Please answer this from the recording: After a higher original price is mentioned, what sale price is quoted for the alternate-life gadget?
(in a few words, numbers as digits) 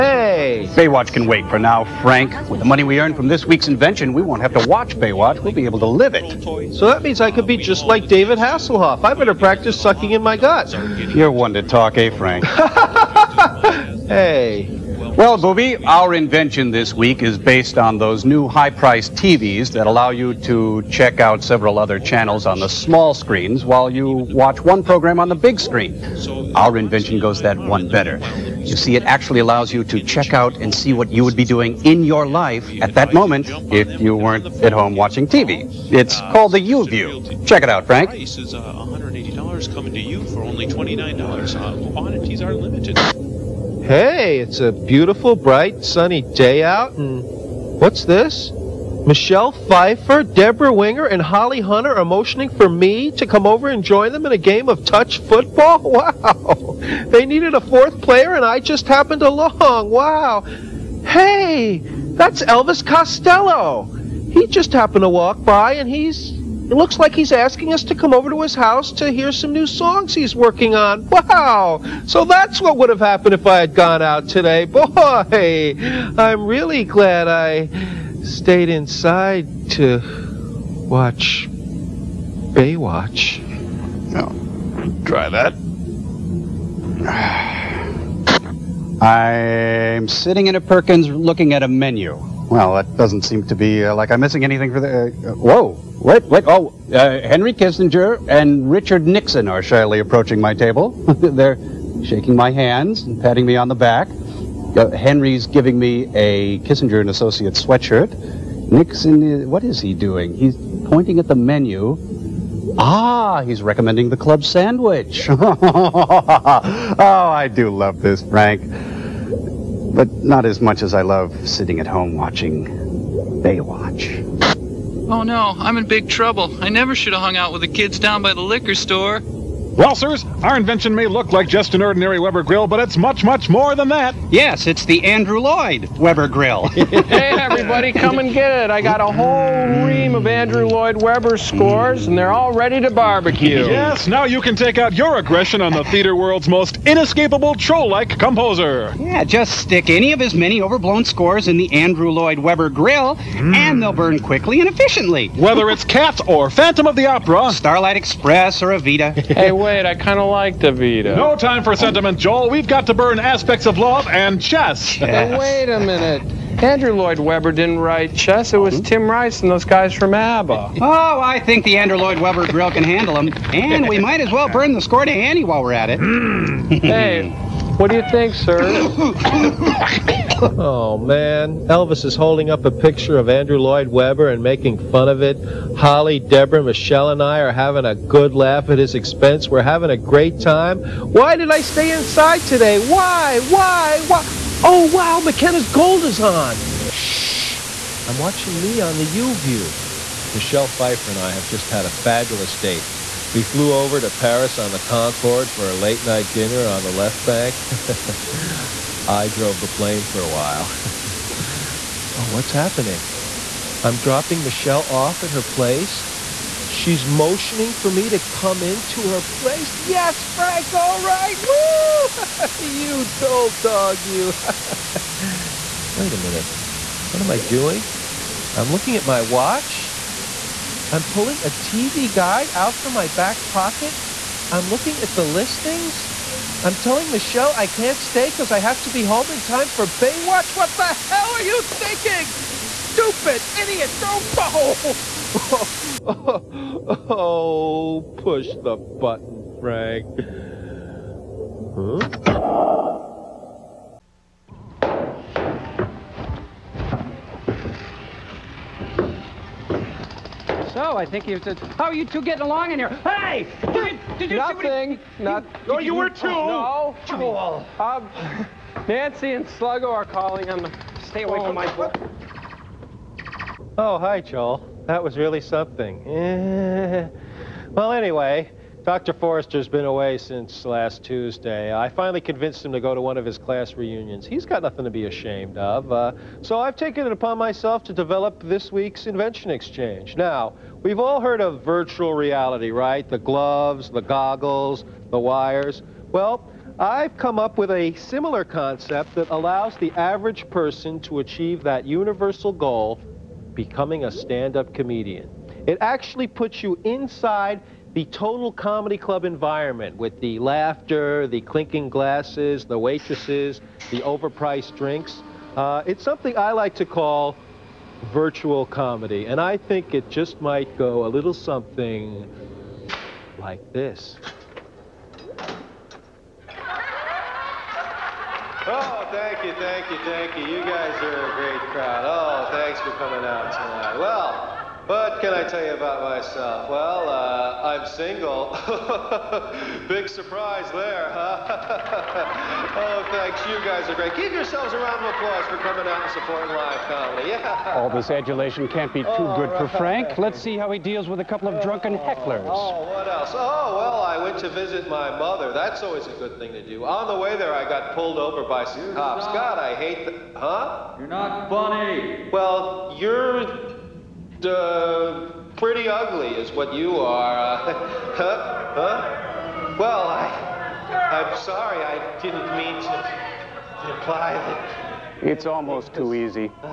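$29.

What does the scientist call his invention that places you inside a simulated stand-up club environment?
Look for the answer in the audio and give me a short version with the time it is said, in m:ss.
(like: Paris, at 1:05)
virtual comedy, at 5:18.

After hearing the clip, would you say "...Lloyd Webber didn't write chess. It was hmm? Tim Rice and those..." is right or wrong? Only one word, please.
right.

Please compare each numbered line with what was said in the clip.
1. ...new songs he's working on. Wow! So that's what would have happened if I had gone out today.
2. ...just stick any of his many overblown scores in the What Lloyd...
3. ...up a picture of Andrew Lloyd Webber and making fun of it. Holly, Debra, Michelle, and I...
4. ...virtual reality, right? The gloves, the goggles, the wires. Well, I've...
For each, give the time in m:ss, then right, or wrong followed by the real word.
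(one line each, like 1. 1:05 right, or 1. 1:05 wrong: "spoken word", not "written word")
1. 1:09 right
2. 2:29 wrong: "Andrew", not "What"
3. 3:02 right
4. 4:51 right.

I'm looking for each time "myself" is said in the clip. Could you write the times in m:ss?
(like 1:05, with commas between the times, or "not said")
4:47, 5:36.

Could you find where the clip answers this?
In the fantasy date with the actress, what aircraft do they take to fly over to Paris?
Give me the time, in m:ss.
3:24.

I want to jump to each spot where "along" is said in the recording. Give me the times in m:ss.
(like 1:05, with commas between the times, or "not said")
0:59, 4:22.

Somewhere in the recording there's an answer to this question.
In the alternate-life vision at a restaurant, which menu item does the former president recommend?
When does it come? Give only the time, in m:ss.
1:54.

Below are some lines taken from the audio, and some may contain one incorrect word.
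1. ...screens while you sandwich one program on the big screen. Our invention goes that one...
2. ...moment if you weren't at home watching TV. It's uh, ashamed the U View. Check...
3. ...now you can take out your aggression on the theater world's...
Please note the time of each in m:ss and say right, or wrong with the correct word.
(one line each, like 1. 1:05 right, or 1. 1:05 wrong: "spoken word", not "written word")
1. 0:23 wrong: "watch", not "sandwich"
2. 0:33 wrong: "called", not "ashamed"
3. 2:24 right.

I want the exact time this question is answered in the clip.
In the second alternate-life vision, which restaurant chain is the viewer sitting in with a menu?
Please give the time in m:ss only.
1:30.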